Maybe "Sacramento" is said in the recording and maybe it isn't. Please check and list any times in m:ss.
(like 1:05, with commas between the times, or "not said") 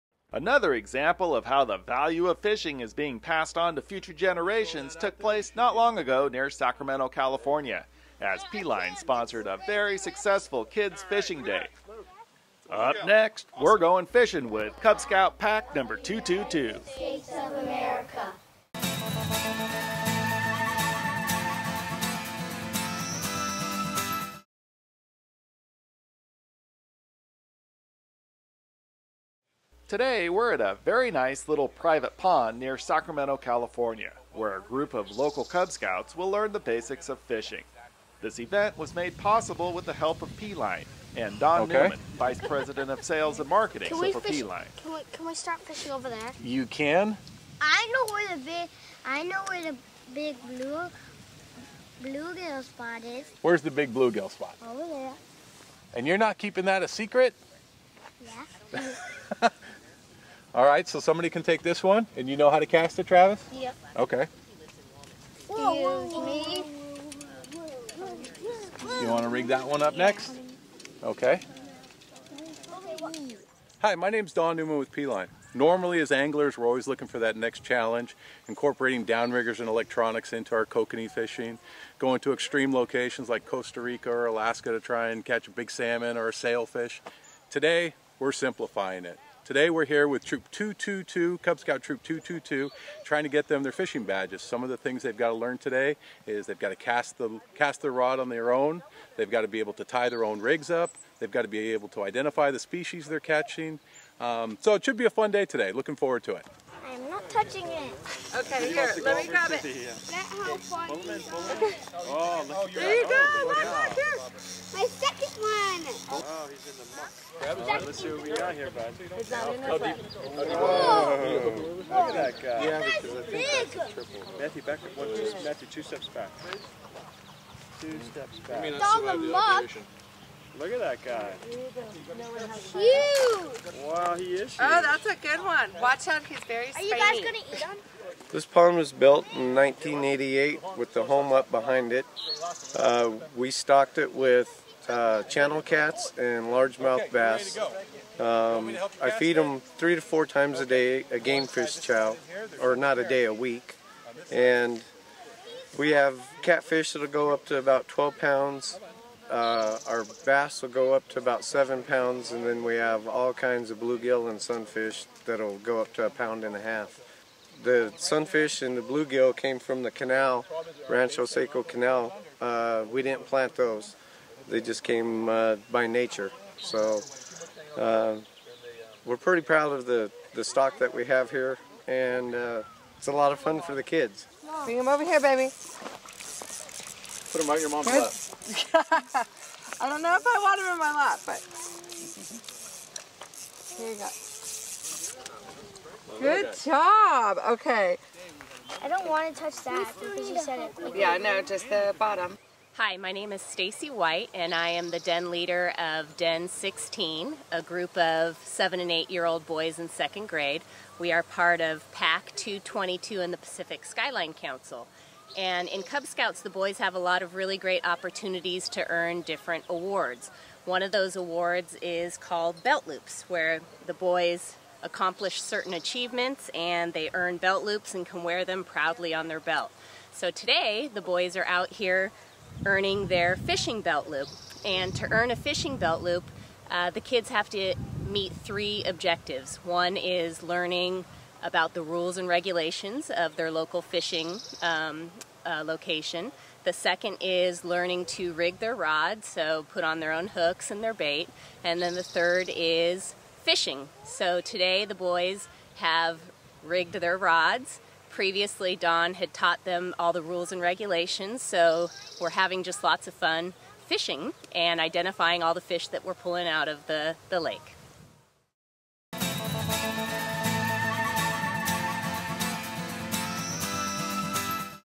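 0:06, 0:32.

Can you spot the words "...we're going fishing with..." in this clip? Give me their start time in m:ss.
0:13.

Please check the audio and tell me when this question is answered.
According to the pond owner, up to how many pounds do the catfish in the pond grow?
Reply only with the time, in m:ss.
2:37.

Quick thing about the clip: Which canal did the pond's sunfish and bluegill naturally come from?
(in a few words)
Rancho Seco Canal.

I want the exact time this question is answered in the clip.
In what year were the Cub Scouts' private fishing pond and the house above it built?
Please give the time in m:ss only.
2:19.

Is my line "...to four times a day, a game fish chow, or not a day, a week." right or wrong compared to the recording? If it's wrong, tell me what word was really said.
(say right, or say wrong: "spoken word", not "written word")
right.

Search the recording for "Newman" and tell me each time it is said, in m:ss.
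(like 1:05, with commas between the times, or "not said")
0:41, 1:14.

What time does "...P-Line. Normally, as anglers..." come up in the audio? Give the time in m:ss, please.
1:14.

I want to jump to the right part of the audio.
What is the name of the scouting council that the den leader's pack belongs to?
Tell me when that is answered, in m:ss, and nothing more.
3:33.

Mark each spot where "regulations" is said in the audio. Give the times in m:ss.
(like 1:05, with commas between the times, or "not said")
4:02, 4:20.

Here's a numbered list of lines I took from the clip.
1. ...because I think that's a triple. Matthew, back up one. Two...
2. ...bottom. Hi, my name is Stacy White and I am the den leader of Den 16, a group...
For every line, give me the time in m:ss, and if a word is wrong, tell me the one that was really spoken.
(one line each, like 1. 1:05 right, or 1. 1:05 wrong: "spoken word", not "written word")
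1. 2:02 right
2. 3:21 right.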